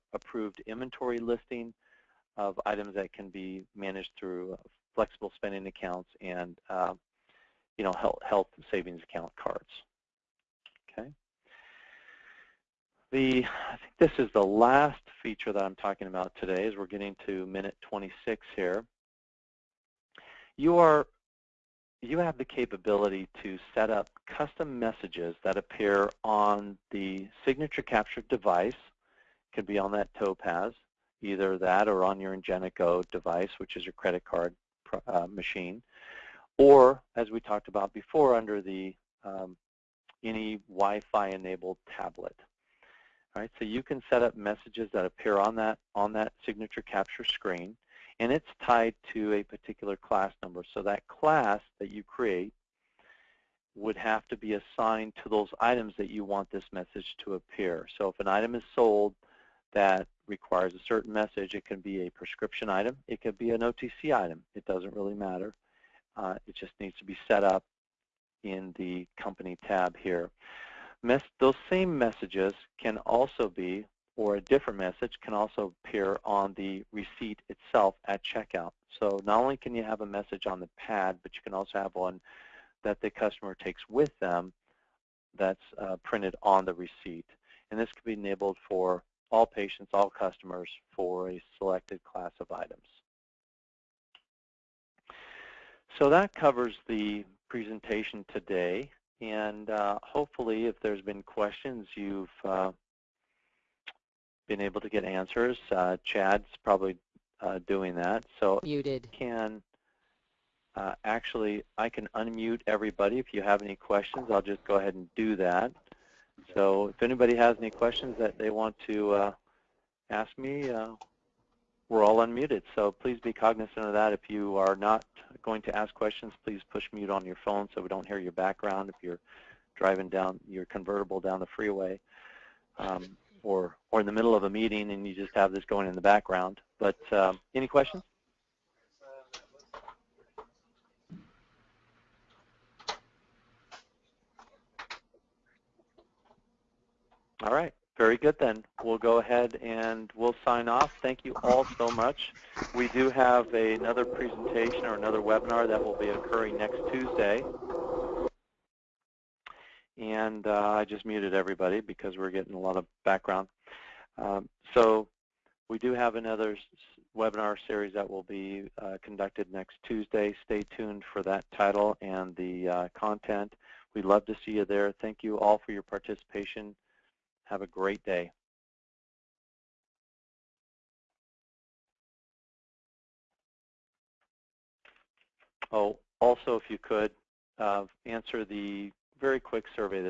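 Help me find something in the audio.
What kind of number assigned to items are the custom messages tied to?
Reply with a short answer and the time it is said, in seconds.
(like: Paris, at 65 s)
class number, at 49 s.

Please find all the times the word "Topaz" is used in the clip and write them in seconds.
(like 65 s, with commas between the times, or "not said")
30 s.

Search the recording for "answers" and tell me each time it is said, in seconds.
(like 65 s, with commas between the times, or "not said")
105 s, 188 s.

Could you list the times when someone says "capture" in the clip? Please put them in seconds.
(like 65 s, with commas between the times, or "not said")
27 s, 46 s.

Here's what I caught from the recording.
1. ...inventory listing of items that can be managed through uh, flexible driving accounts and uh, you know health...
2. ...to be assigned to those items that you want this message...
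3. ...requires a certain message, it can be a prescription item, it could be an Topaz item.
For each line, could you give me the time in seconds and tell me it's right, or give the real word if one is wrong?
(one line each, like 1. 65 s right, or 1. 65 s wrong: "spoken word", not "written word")
1. 0 s wrong: "spending", not "driving"
2. 54 s right
3. 60 s wrong: "OTC", not "Topaz".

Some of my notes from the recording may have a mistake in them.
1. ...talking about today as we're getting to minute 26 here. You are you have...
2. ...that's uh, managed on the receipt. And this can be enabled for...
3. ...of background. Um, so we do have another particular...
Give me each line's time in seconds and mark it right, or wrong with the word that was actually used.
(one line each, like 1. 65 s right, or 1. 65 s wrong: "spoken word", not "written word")
1. 15 s right
2. 85 s wrong: "printed", not "managed"
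3. 162 s wrong: "webinar", not "particular".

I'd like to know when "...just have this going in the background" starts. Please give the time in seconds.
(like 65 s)
135 s.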